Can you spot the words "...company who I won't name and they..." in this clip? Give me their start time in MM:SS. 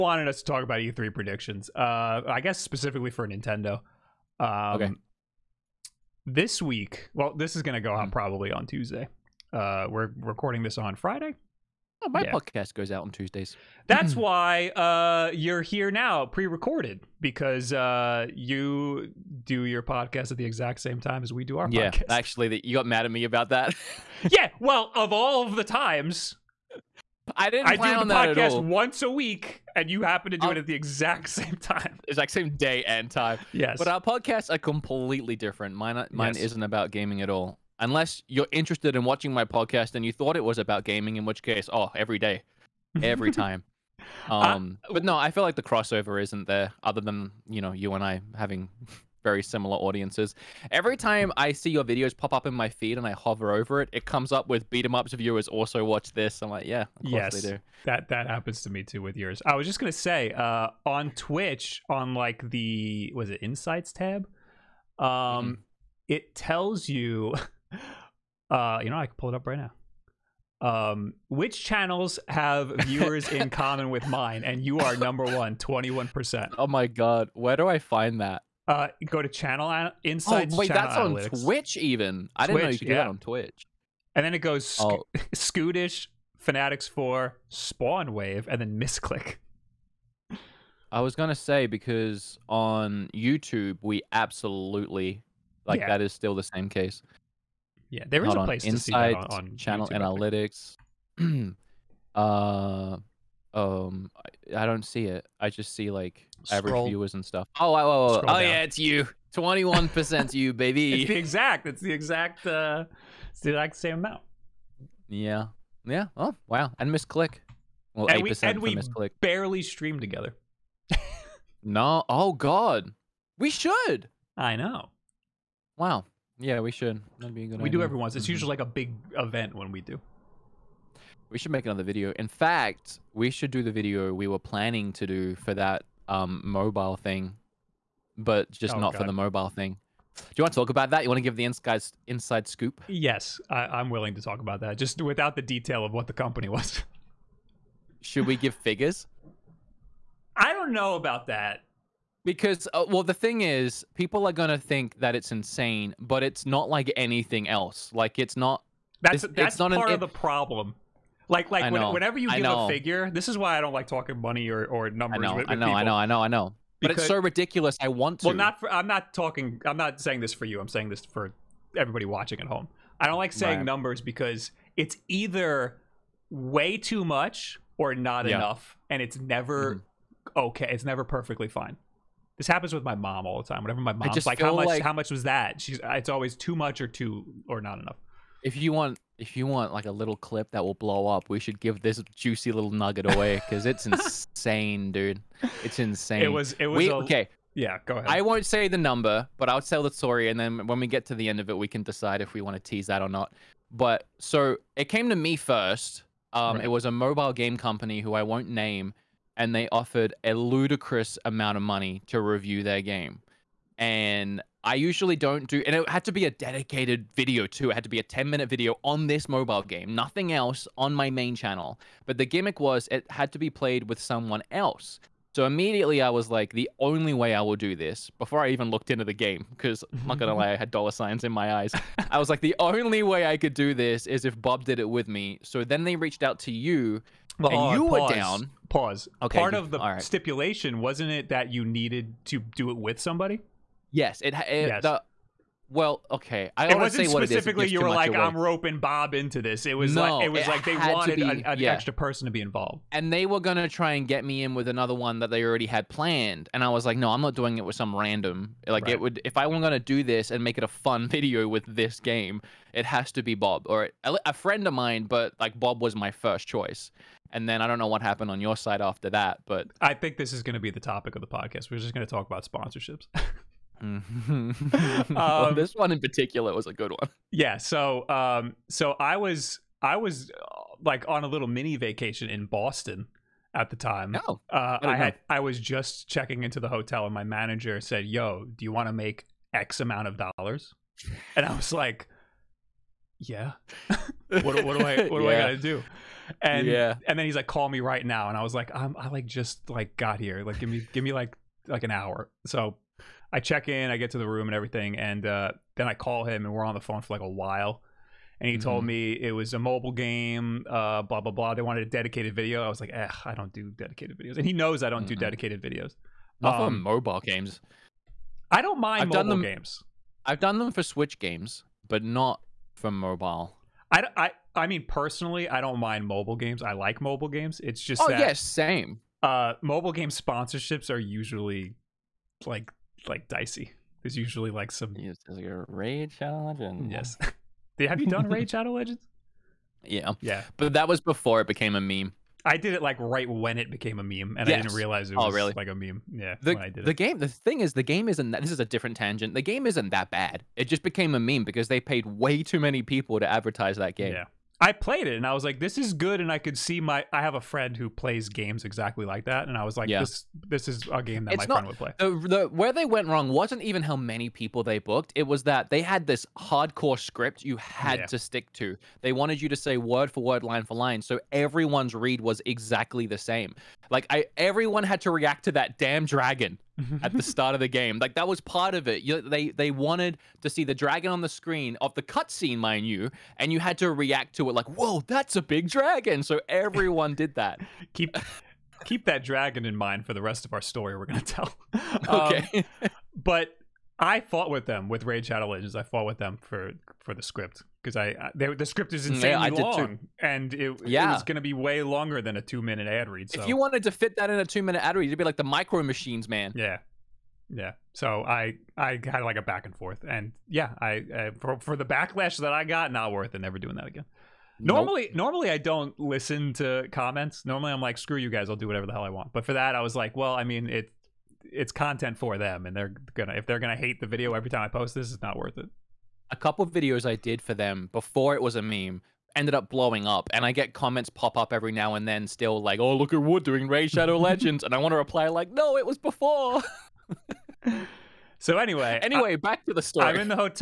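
03:27.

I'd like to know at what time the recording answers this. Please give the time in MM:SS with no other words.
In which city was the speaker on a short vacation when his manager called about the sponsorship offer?
04:42.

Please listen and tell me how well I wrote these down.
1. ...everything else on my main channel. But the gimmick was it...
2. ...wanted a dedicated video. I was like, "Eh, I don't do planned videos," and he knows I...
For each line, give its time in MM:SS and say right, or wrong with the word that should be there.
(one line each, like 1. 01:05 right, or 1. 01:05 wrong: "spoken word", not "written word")
1. 03:39 wrong: "nothing", not "everything"
2. 05:11 wrong: "dedicated", not "planned".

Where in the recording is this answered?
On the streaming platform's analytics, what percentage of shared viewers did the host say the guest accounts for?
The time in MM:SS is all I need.
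01:15.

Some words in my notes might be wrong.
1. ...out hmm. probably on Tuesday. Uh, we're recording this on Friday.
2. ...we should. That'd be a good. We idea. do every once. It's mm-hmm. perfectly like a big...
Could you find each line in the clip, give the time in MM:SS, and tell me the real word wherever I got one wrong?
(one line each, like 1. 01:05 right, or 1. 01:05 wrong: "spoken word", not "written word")
1. 00:07 right
2. 02:06 wrong: "usually", not "perfectly".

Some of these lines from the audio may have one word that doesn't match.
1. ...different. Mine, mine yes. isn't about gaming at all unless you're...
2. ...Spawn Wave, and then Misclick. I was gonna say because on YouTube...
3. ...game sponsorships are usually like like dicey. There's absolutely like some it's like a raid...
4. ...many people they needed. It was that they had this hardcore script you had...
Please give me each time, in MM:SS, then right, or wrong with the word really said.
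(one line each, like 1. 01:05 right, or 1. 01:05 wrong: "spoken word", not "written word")
1. 00:35 right
2. 01:27 right
3. 05:29 wrong: "usually", not "absolutely"
4. 06:03 wrong: "booked", not "needed".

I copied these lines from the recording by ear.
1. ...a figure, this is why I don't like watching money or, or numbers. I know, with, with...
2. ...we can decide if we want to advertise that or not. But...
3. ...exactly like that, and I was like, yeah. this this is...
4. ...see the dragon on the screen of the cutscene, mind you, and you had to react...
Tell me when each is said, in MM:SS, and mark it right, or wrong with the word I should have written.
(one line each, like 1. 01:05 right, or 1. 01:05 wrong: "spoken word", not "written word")
1. 02:42 wrong: "talking", not "watching"
2. 03:21 wrong: "tease", not "advertise"
3. 05:58 right
4. 06:20 right.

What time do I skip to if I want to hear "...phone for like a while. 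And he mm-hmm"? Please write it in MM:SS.
05:06.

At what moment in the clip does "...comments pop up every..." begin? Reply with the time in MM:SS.
07:10.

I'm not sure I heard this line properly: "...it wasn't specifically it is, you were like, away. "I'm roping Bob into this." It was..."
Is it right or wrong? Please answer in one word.
right.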